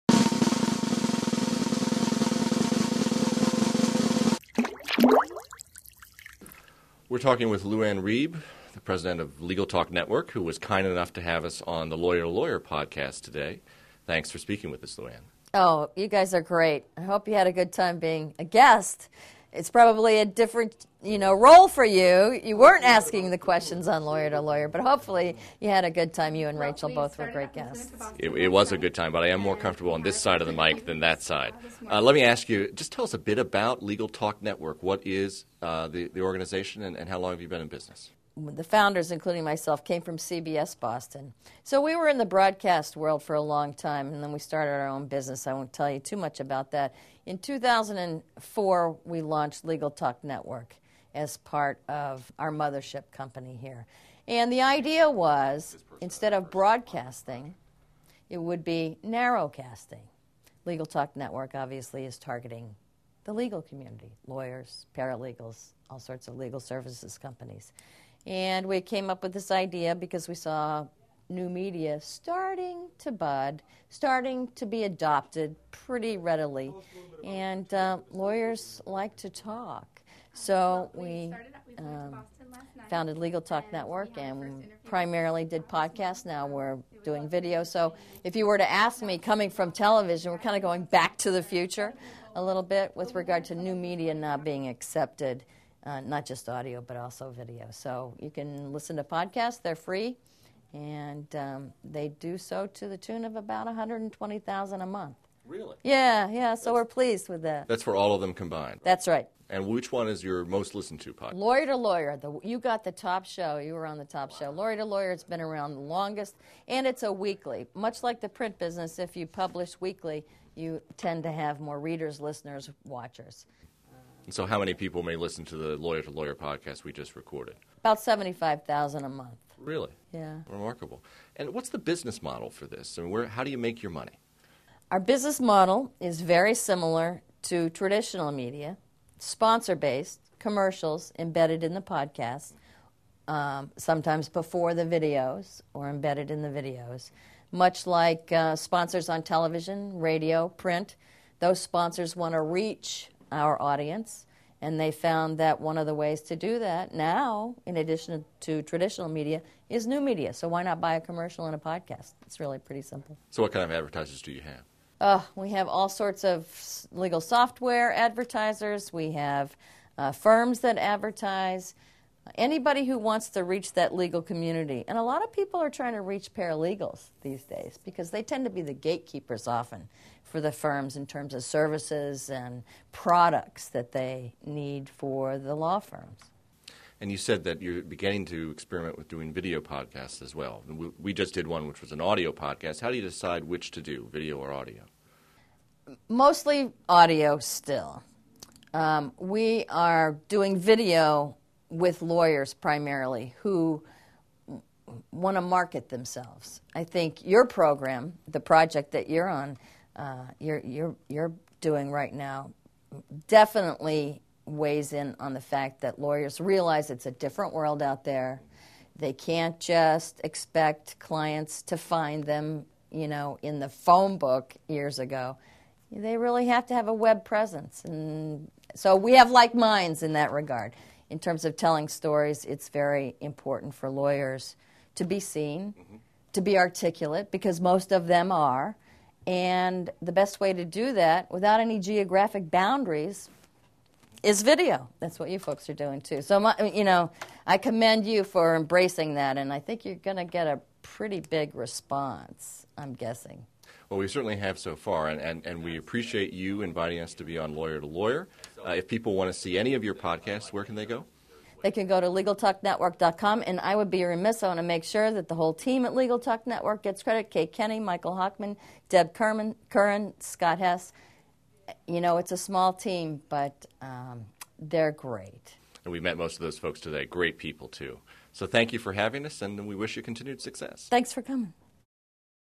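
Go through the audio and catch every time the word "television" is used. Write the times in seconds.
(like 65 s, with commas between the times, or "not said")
89 s, 149 s.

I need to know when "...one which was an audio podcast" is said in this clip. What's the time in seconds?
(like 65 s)
191 s.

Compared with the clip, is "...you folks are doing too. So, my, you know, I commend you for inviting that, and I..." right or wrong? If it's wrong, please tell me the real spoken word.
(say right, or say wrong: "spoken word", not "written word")
wrong: "embracing", not "inviting".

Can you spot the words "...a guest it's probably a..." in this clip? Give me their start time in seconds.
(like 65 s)
18 s.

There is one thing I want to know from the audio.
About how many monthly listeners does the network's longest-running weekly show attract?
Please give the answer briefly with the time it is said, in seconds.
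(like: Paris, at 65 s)
75,000, at 127 s.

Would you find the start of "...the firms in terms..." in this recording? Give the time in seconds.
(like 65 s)
180 s.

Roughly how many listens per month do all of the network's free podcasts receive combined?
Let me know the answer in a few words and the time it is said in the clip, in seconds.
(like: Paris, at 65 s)
120,000, at 103 s.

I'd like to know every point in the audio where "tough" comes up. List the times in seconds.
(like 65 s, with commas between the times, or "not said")
not said.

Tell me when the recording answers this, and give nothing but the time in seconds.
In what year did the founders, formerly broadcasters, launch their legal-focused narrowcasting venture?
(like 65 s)
47 s.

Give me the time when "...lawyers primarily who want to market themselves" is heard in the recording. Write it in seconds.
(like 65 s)
202 s.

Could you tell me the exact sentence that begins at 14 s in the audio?
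Thanks for speaking with us, Lu Ann.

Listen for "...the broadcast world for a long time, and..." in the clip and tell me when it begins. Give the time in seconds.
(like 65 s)
42 s.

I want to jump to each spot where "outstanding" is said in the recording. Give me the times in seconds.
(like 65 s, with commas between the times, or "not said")
not said.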